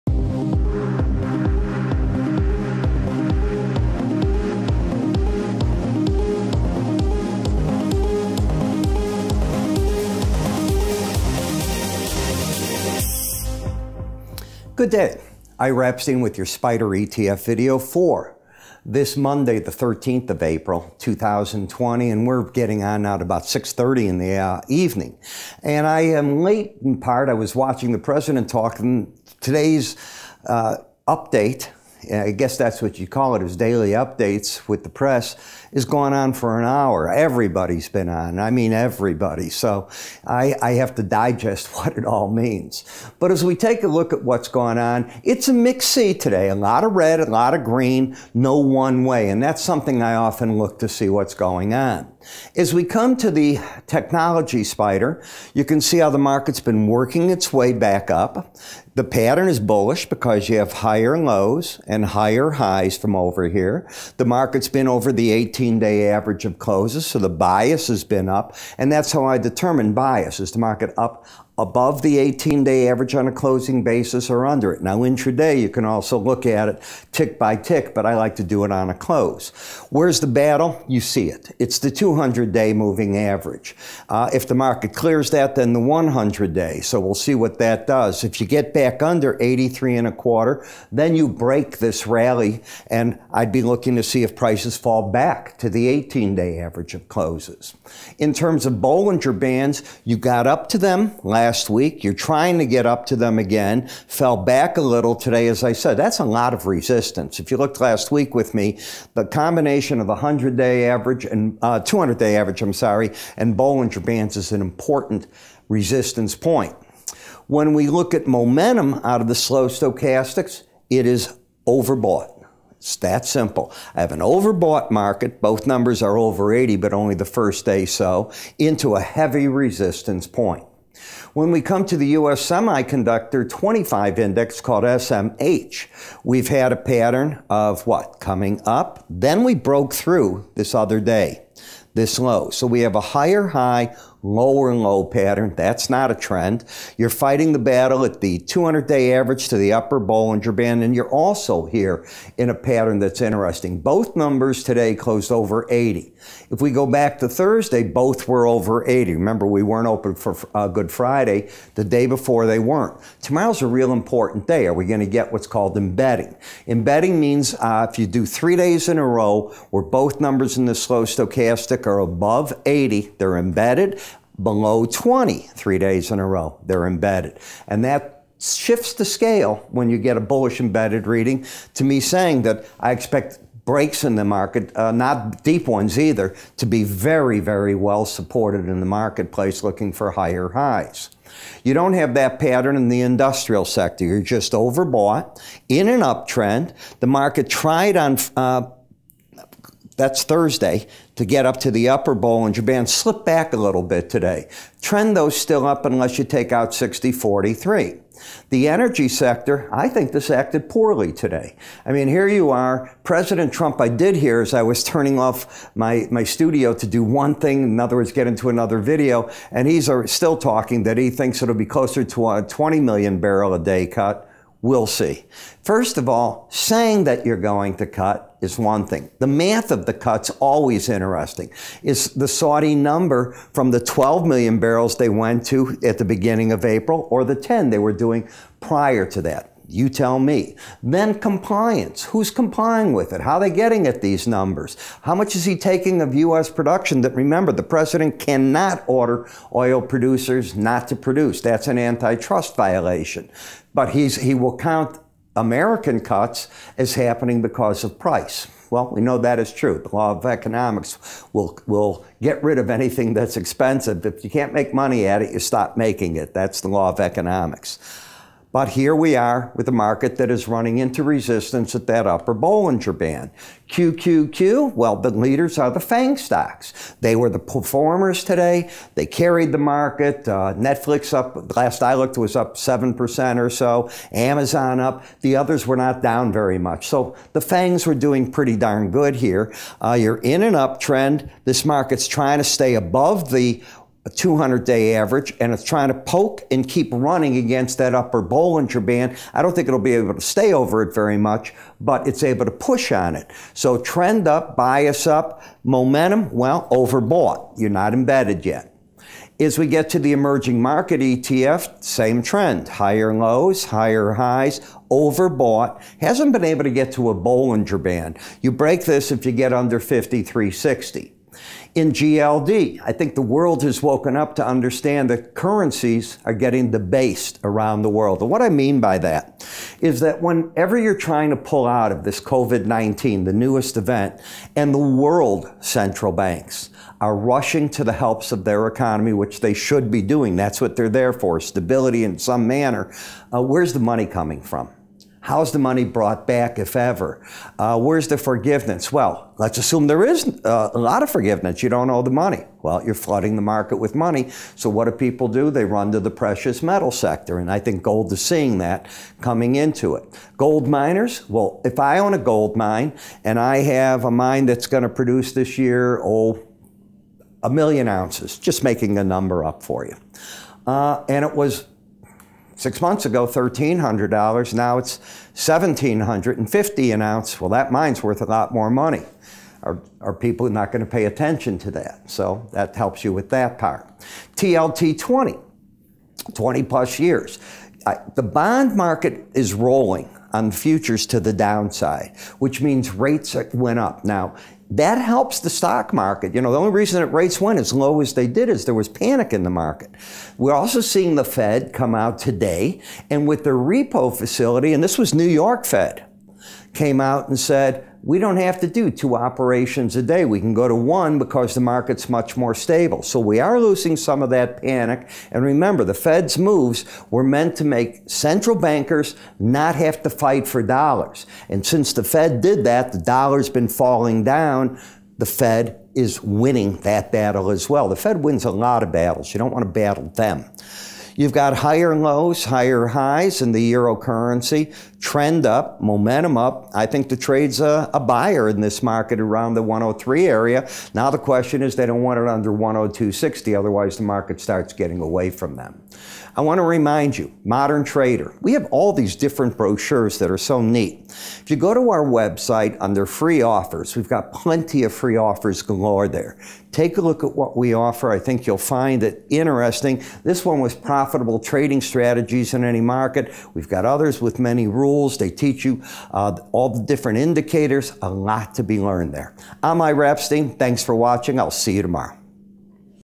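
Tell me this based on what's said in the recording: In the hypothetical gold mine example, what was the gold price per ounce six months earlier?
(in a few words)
$1,300.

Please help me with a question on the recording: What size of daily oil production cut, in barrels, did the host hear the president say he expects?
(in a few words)
20 million barrels.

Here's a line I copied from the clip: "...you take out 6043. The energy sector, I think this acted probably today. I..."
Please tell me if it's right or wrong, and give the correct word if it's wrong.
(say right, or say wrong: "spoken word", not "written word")
wrong: "poorly", not "probably".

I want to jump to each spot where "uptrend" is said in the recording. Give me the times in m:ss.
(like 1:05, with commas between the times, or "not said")
3:16, 4:50.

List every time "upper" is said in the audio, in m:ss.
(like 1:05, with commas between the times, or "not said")
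2:29, 3:21, 4:32, 4:57.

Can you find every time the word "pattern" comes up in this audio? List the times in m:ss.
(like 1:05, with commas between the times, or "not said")
0:59, 2:16, 2:25, 2:32, 3:12.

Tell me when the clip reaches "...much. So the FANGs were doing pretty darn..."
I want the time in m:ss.
4:46.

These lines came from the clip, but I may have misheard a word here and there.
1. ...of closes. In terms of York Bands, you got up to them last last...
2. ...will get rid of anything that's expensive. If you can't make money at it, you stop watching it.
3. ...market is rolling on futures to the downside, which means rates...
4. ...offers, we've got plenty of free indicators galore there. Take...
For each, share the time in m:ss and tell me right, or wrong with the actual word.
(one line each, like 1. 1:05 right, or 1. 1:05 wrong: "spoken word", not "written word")
1. 1:36 wrong: "Bollinger", not "York"
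2. 4:21 wrong: "making", not "watching"
3. 6:28 right
4. 7:33 wrong: "offers", not "indicators".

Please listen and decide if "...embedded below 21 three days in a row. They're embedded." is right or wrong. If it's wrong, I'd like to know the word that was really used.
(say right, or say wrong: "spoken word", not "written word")
wrong: "20", not "21".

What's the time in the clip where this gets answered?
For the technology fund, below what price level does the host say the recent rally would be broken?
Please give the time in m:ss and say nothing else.
1:29.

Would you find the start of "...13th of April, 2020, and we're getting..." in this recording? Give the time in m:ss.
0:19.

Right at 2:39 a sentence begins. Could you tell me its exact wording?
Remember, we weren't open for uh, Good Friday.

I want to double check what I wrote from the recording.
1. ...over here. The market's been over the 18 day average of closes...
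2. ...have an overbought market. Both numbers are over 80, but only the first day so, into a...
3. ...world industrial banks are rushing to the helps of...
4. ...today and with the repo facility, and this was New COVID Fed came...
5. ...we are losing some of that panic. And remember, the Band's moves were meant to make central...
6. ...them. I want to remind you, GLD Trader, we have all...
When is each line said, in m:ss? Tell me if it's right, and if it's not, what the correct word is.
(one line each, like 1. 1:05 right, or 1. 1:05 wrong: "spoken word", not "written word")
1. 1:03 right
2. 2:03 right
3. 5:34 wrong: "central", not "industrial"
4. 6:42 wrong: "York", not "COVID"
5. 6:53 wrong: "Fed", not "Band"
6. 7:25 wrong: "Modern", not "GLD".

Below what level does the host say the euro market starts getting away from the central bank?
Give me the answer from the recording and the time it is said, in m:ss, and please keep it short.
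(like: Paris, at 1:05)
102.60, at 7:22.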